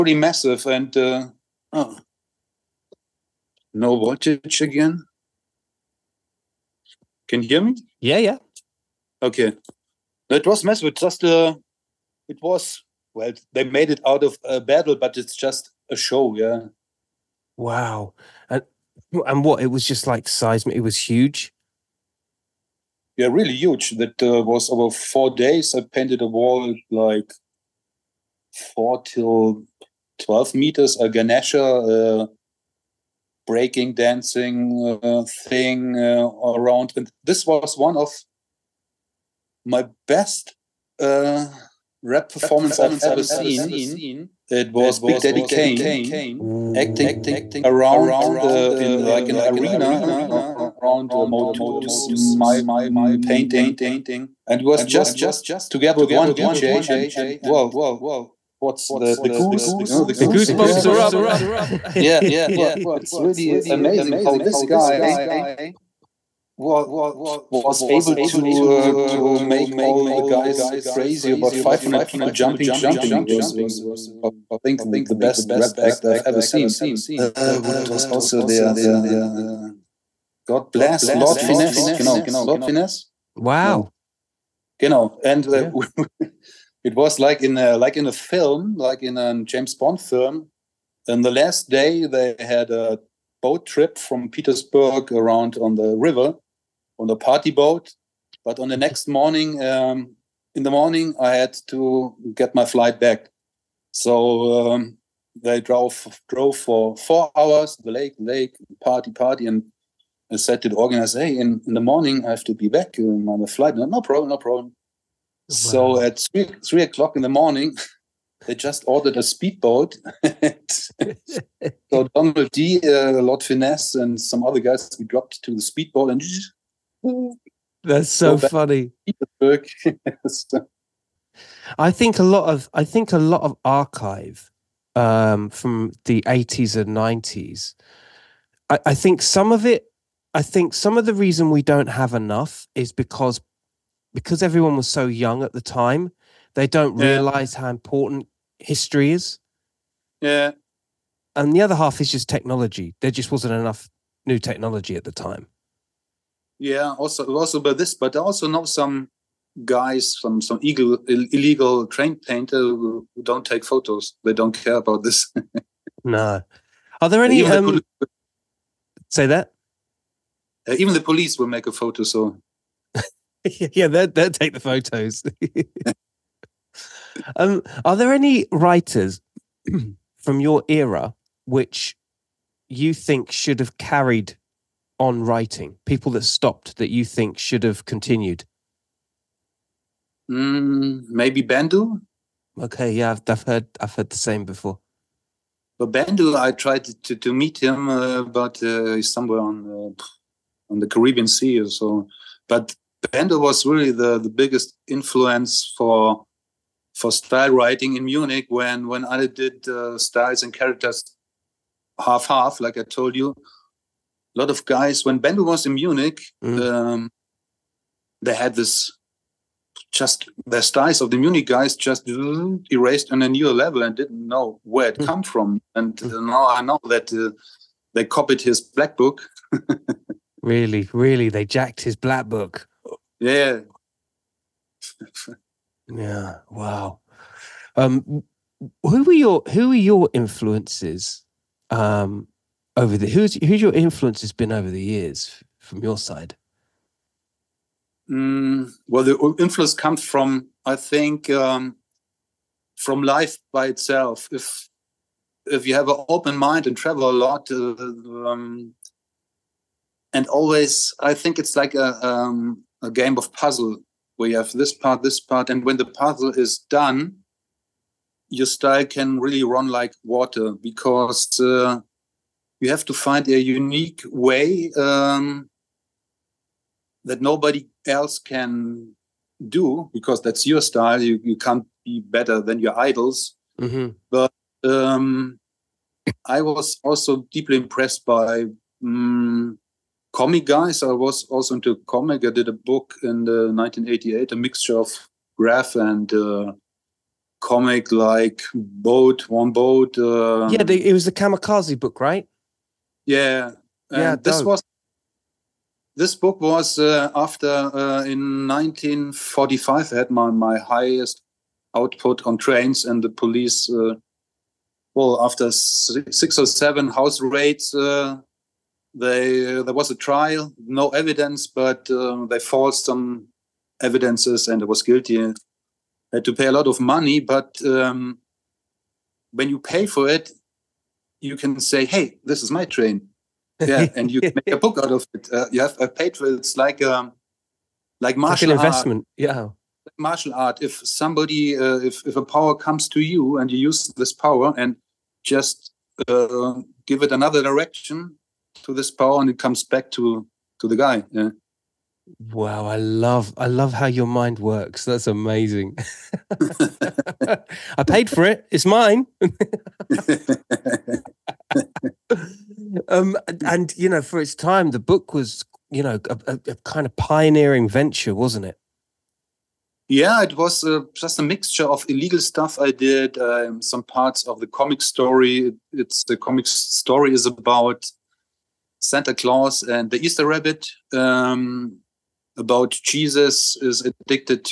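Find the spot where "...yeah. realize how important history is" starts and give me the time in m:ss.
2:26.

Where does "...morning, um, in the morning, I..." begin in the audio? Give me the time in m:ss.
1:39.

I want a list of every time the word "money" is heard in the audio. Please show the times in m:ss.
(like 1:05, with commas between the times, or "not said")
5:26.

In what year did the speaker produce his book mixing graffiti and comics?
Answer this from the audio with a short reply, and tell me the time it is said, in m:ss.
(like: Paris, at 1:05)
1988, at 4:53.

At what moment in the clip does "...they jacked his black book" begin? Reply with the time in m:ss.
3:51.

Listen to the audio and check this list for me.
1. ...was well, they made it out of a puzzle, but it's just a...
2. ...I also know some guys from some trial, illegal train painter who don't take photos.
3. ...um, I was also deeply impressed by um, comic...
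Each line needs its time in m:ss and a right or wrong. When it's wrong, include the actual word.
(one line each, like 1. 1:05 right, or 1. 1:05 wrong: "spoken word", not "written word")
1. 0:12 wrong: "battle", not "puzzle"
2. 2:38 wrong: "illegal", not "trial"
3. 4:44 right.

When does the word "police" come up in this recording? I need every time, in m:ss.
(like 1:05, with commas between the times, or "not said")
2:51, 5:13.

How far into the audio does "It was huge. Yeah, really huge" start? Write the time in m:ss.
0:20.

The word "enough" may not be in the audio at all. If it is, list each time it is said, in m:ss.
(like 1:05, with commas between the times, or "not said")
2:22, 2:33.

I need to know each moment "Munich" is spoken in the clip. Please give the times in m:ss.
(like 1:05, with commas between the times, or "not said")
3:28, 3:35, 3:41.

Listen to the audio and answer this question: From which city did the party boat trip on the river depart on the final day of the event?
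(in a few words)
Petersburg.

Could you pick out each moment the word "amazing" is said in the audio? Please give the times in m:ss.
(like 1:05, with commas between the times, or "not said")
1:03, 5:55.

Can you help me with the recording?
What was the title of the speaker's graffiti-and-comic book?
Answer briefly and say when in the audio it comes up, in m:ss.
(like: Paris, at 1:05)
Kamikaze, at 5:01.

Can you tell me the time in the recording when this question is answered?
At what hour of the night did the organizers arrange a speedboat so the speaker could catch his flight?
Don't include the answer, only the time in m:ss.
1:56.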